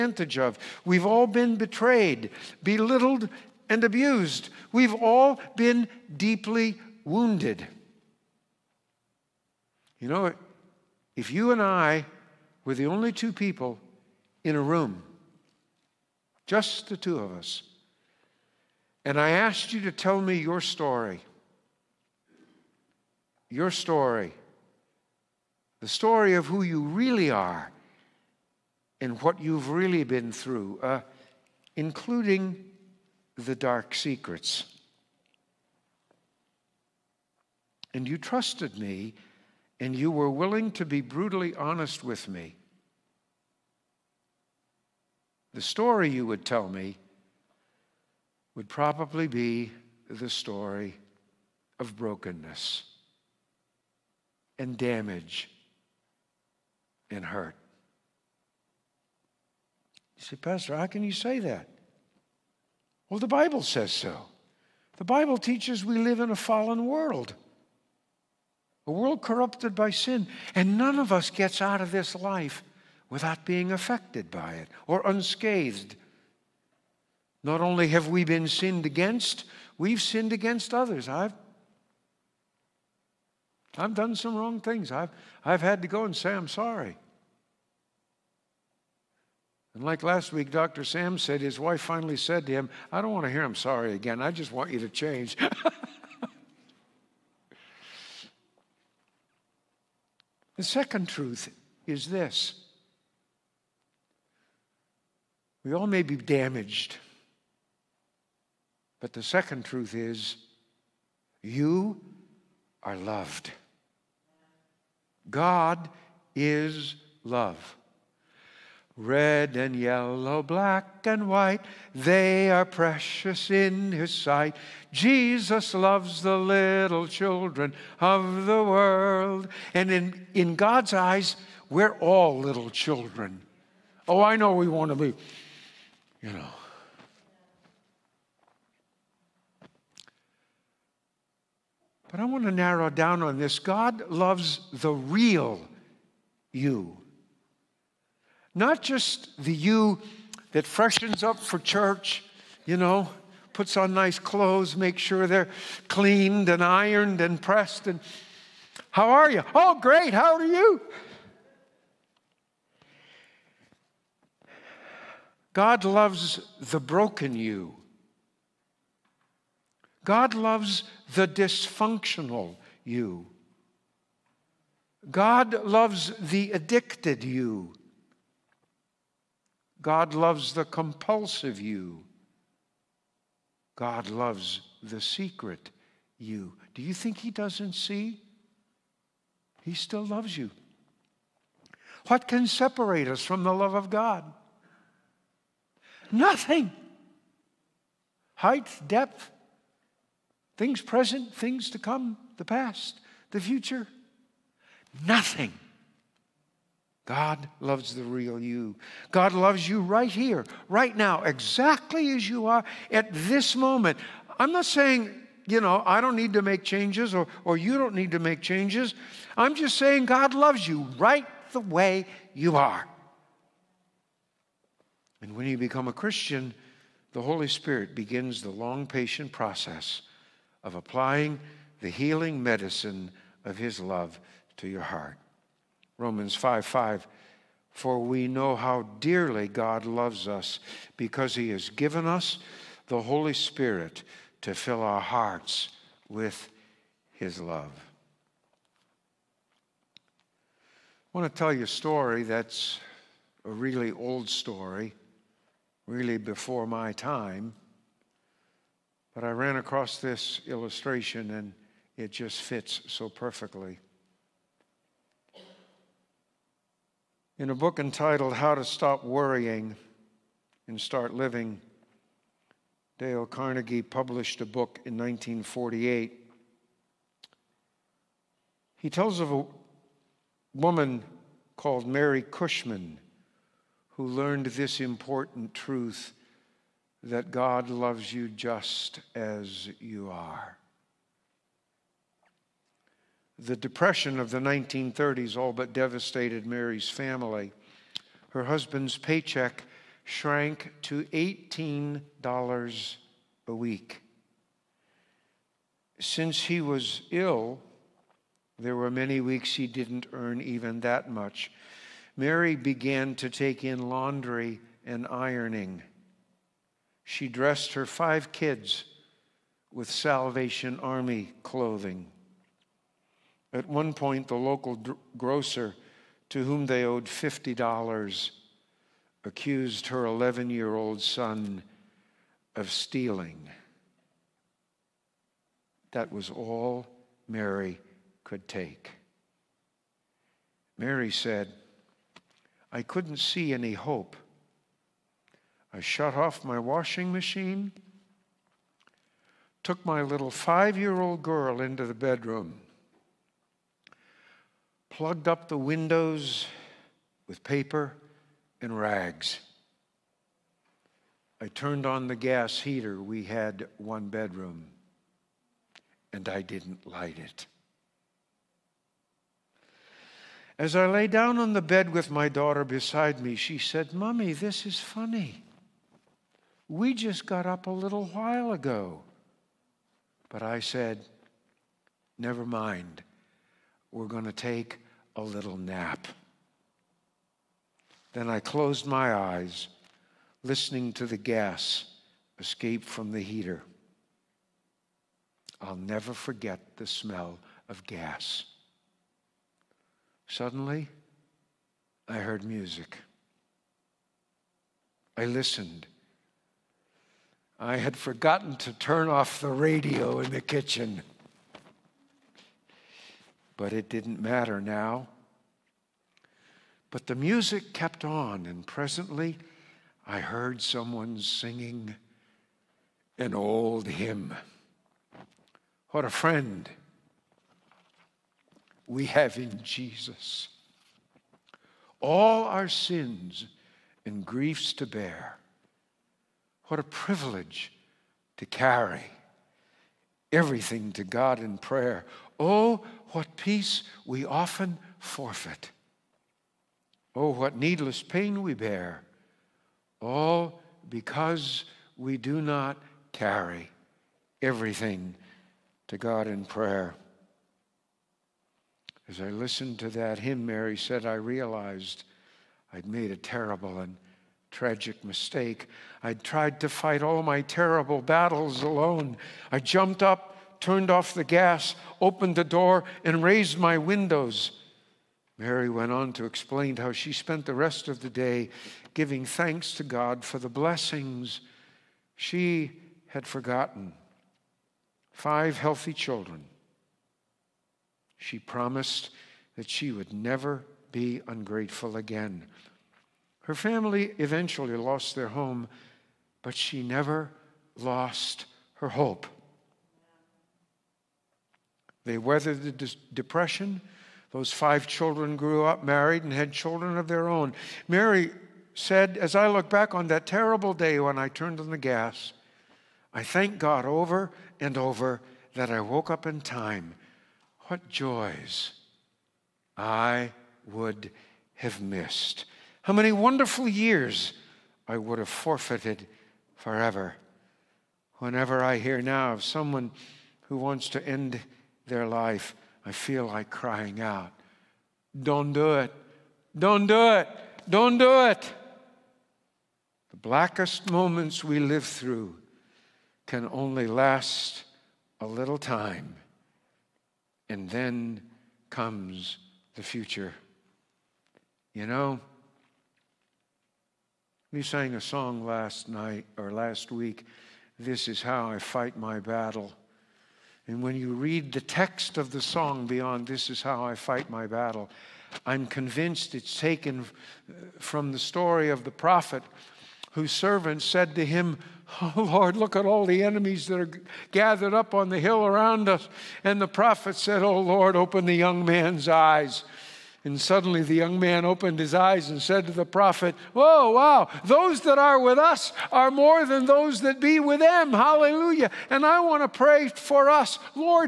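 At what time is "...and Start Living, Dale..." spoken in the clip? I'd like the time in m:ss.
4:30.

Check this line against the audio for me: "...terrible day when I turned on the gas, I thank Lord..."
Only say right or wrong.
wrong.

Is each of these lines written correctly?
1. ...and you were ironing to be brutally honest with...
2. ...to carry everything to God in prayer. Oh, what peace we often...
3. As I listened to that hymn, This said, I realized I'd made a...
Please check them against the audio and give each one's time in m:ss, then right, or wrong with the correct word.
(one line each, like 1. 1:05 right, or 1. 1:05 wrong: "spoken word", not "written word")
1. 0:39 wrong: "willing", not "ironing"
2. 7:18 right
3. 7:39 wrong: "Mary", not "This".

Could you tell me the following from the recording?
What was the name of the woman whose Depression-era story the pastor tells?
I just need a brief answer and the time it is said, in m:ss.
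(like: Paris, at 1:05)
Mary Cushman, at 4:41.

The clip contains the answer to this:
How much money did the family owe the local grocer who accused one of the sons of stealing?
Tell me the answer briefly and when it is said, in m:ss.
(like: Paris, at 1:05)
$50, at 5:27.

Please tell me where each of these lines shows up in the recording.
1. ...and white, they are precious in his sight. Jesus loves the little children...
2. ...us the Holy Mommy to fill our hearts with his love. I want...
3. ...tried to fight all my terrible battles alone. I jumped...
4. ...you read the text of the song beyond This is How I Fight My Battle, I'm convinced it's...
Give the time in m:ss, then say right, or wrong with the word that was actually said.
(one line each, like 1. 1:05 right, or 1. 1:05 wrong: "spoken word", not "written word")
1. 2:01 right
2. 4:02 wrong: "Spirit", not "Mommy"
3. 7:46 right
4. 9:20 right.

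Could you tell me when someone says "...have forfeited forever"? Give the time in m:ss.
8:45.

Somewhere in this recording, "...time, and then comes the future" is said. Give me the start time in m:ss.
9:05.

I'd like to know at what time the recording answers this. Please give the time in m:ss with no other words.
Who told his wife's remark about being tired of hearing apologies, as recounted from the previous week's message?
1:30.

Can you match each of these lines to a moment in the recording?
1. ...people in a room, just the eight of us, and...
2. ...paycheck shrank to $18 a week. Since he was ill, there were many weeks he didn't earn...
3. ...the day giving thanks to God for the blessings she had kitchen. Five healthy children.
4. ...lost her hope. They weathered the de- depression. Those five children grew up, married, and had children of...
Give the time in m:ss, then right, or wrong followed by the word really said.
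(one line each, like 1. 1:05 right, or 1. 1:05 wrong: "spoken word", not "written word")
1. 0:13 wrong: "two", not "eight"
2. 4:58 right
3. 7:58 wrong: "forgotten", not "kitchen"
4. 8:17 right.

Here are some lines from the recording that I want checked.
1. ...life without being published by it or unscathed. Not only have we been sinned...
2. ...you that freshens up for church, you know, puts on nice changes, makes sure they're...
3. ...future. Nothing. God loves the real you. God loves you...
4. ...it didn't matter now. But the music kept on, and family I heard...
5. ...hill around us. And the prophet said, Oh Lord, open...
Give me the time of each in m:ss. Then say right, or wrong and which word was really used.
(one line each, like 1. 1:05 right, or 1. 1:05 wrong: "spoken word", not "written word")
1. 1:12 wrong: "affected", not "published"
2. 2:29 wrong: "clothes", not "changes"
3. 3:23 right
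4. 6:53 wrong: "presently", not "family"
5. 9:35 right.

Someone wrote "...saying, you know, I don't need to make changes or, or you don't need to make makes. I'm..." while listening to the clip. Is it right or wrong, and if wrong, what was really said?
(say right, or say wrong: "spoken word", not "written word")
wrong: "changes", not "makes".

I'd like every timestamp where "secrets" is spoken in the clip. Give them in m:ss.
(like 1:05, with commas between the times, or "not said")
0:33, 3:05.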